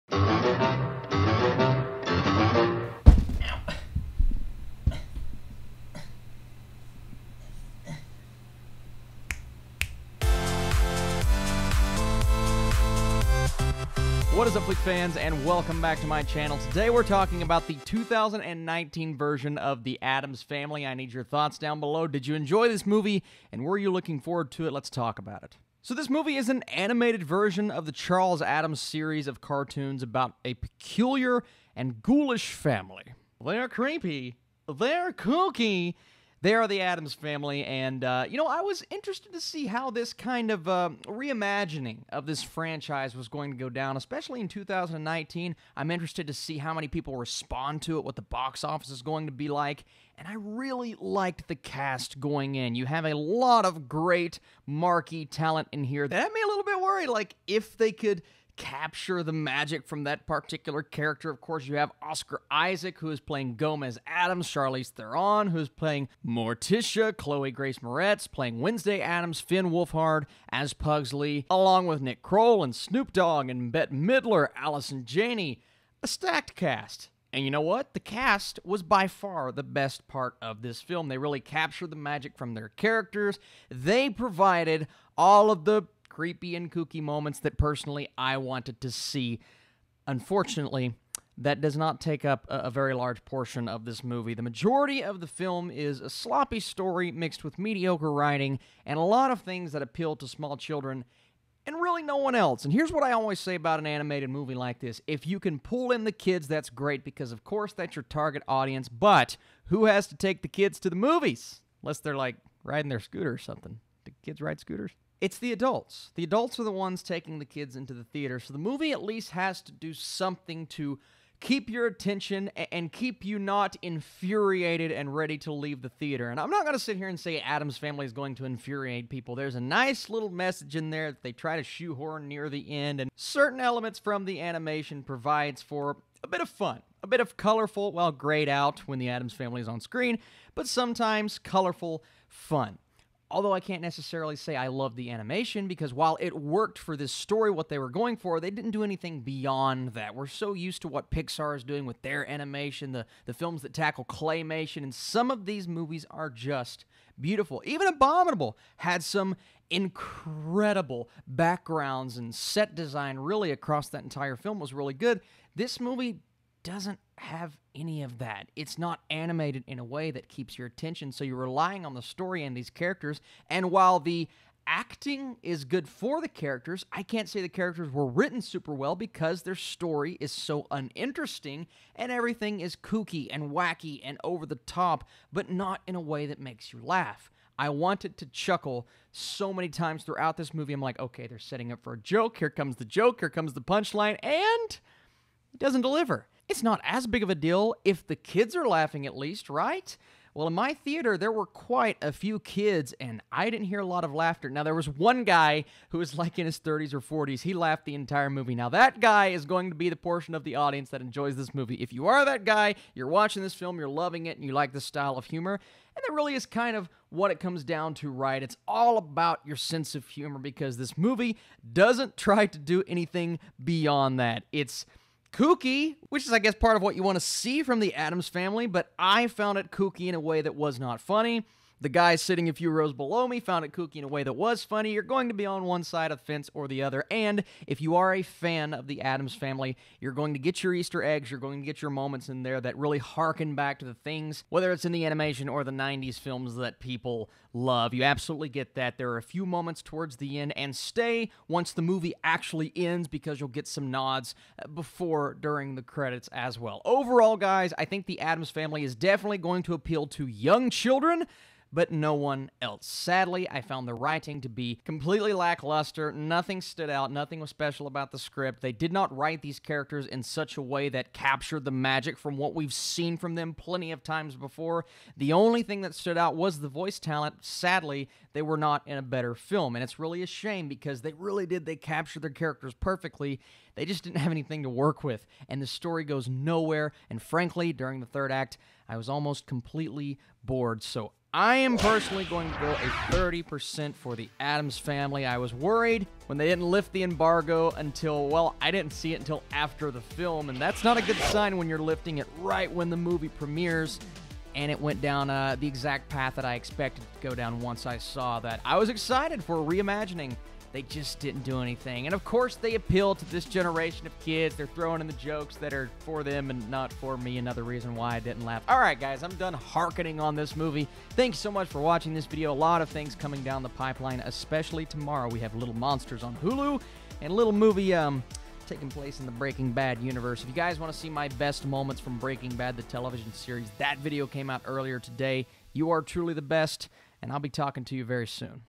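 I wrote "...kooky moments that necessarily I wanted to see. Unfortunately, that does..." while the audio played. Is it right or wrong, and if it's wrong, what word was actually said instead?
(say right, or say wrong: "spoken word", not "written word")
wrong: "personally", not "necessarily".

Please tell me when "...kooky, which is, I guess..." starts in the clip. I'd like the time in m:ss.
3:45.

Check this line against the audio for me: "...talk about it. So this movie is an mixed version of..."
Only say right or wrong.
wrong.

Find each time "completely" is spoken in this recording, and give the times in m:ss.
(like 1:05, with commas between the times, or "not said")
4:24, 4:49.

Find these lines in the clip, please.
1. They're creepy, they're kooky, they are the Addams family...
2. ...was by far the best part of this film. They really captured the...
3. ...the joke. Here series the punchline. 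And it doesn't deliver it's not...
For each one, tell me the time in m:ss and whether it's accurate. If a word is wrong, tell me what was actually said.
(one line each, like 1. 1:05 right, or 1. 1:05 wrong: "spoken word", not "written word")
1. 0:33 right
2. 1:18 right
3. 3:12 wrong: "comes", not "series".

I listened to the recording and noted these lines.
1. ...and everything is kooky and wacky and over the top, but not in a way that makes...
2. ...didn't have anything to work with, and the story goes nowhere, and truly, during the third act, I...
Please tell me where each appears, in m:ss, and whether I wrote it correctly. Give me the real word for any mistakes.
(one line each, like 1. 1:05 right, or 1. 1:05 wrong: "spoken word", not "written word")
1. 3:01 right
2. 4:44 wrong: "frankly", not "truly".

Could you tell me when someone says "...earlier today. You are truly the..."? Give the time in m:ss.
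5:34.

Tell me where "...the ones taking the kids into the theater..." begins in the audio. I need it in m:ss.
1:56.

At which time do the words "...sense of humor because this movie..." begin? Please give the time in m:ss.
3:39.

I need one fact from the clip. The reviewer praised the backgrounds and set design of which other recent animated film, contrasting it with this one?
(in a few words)
Abominable.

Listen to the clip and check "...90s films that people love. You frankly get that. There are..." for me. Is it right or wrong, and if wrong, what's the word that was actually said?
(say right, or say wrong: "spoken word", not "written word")
wrong: "absolutely", not "frankly".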